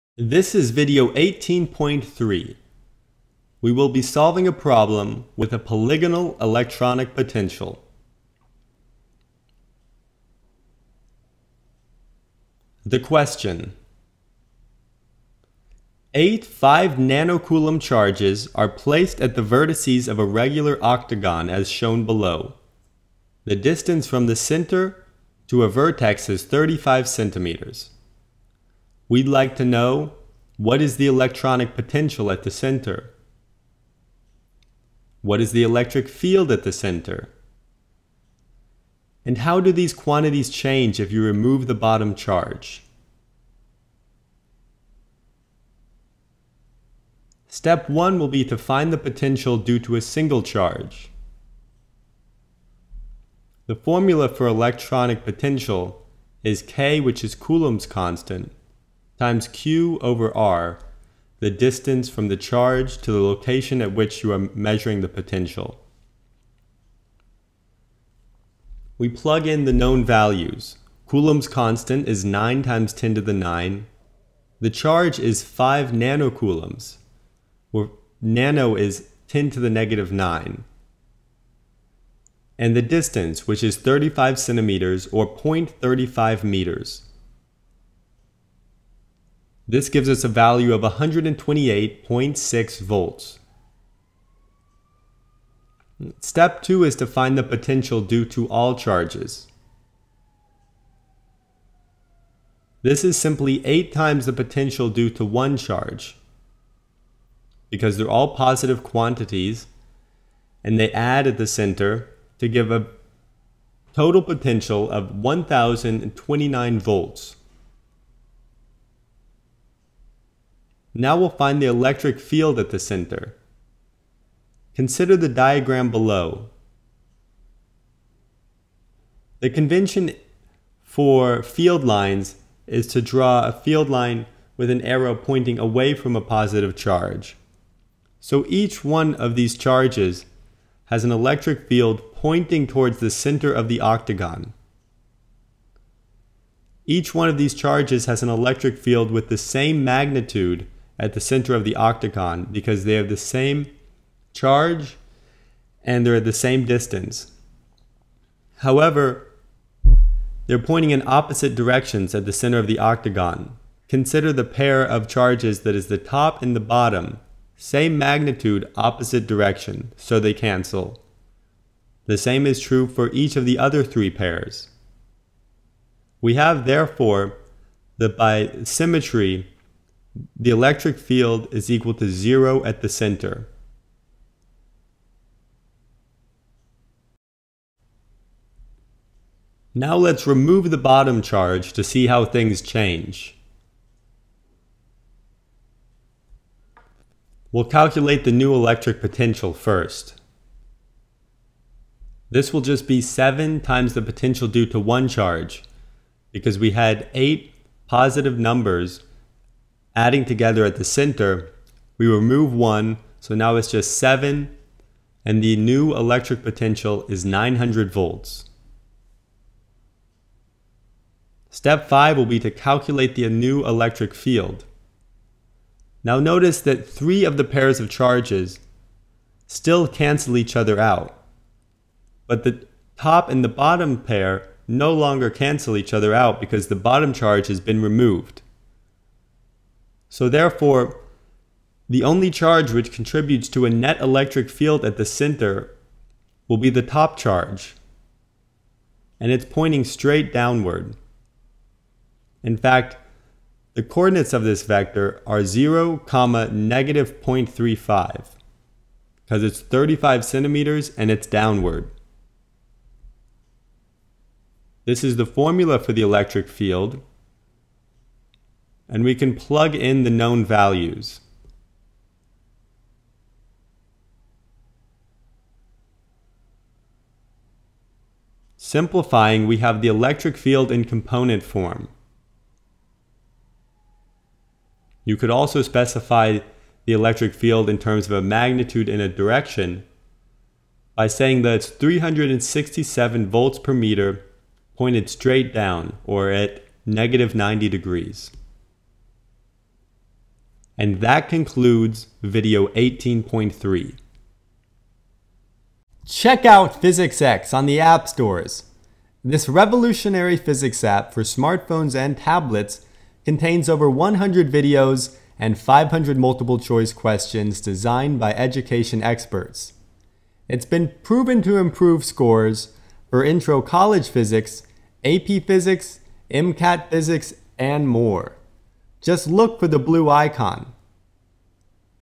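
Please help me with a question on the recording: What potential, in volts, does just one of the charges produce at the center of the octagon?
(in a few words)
128.6 volts.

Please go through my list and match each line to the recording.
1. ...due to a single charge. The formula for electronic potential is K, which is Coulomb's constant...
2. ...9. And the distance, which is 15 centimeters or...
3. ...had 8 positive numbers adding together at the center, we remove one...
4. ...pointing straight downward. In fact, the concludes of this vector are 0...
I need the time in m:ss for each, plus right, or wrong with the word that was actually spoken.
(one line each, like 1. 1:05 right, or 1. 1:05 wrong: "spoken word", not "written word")
1. 0:49 right
2. 1:20 wrong: "35", not "15"
3. 3:26 right
4. 4:09 wrong: "coordinates", not "concludes".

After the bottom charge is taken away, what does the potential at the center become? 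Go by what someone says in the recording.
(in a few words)
900 volts.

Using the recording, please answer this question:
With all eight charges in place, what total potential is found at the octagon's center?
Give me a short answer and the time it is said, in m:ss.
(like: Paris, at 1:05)
1029 volts, at 1:55.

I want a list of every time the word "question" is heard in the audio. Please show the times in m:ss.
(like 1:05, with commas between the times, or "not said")
0:12, 5:16.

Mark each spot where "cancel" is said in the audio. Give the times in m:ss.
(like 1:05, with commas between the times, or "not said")
2:50, 3:49, 3:55.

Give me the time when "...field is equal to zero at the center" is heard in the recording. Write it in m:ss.
3:00.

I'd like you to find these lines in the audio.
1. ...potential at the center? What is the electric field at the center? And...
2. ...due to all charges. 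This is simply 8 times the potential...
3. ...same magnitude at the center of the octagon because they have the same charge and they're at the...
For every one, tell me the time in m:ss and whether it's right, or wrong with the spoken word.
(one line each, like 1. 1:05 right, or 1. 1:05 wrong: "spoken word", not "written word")
1. 0:31 right
2. 1:38 right
3. 2:29 right.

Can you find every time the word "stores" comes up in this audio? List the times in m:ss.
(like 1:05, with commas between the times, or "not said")
5:08.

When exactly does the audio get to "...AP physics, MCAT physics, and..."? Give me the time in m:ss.
5:25.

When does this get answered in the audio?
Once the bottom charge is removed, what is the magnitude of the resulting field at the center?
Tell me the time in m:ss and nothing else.
4:51.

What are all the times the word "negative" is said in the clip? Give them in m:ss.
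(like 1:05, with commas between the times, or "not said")
1:19, 4:16, 4:56.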